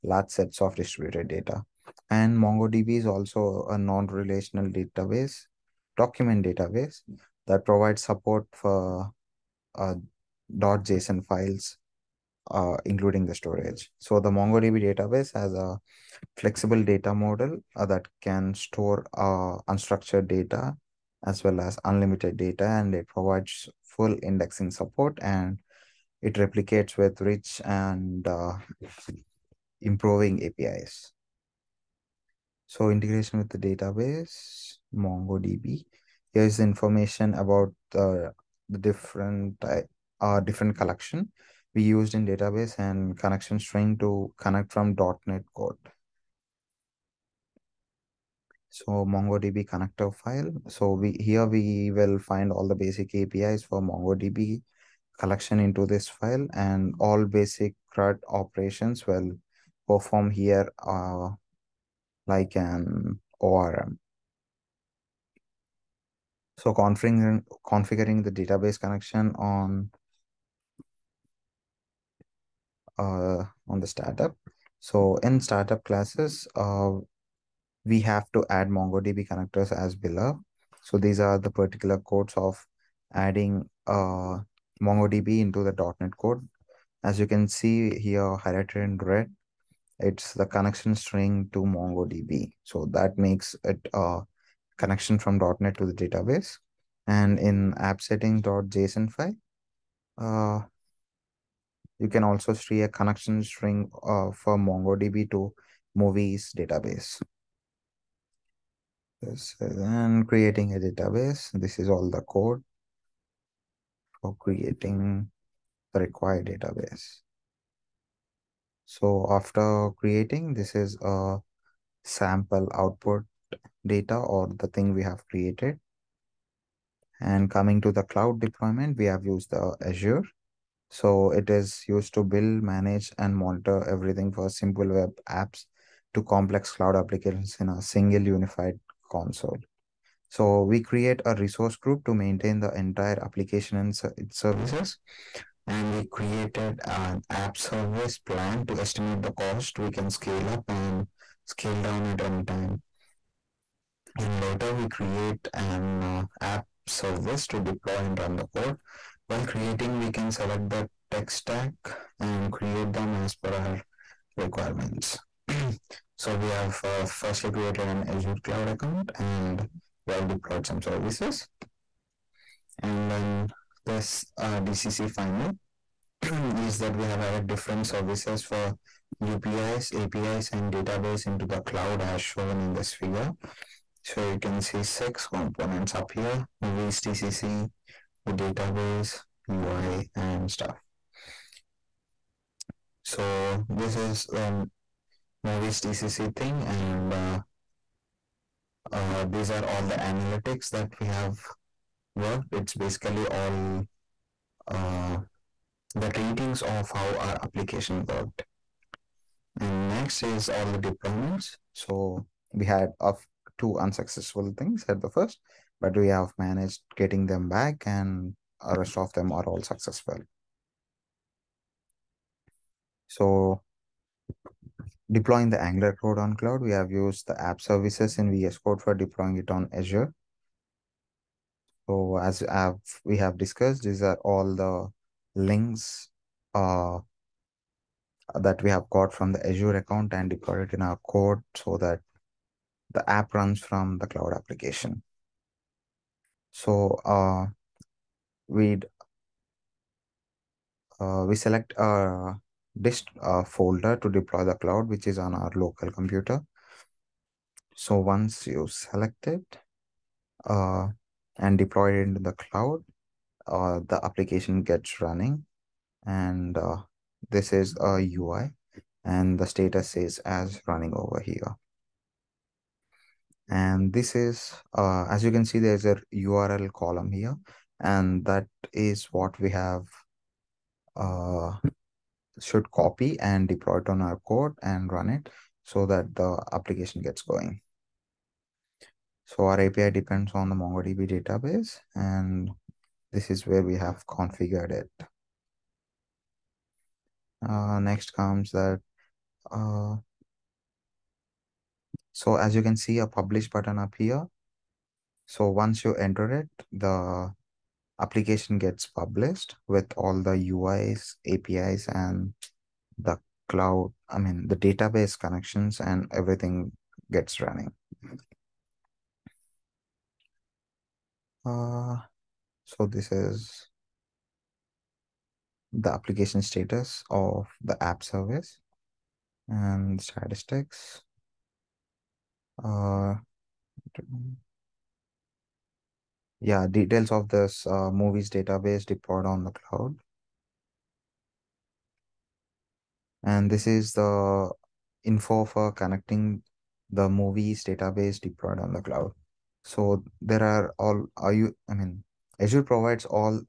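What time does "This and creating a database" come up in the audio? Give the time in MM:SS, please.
01:49.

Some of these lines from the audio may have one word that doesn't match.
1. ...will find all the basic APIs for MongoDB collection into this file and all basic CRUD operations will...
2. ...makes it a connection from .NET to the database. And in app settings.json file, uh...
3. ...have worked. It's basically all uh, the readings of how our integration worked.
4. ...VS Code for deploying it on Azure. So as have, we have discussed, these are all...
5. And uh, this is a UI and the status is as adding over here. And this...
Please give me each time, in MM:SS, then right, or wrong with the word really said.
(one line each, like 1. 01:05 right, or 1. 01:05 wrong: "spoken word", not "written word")
1. 00:51 right
2. 01:33 right
3. 03:21 wrong: "application", not "integration"
4. 03:48 right
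5. 04:26 wrong: "running", not "adding".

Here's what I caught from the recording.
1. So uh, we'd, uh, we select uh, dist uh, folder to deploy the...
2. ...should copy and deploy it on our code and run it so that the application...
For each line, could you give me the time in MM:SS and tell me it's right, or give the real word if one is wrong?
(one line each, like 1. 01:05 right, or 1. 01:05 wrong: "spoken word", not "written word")
1. 04:06 right
2. 04:42 right.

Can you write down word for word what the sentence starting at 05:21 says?
Uh, so this is the application status of the app service and statistics.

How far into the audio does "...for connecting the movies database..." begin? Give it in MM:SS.
05:45.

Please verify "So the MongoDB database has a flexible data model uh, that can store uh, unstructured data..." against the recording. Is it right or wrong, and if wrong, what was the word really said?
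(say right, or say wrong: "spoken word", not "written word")
right.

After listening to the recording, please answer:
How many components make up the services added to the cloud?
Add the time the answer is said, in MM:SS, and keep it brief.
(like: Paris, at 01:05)
6, at 03:04.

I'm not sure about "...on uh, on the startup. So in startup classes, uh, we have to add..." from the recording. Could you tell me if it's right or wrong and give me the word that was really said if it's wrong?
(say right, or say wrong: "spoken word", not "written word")
right.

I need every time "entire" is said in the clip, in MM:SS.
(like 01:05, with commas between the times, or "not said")
02:22.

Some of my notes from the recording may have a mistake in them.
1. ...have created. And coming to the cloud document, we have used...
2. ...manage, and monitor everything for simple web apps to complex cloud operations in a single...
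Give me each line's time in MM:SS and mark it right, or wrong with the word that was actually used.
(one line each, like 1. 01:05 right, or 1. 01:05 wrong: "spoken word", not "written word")
1. 02:05 wrong: "deployment", not "document"
2. 02:12 wrong: "applications", not "operations".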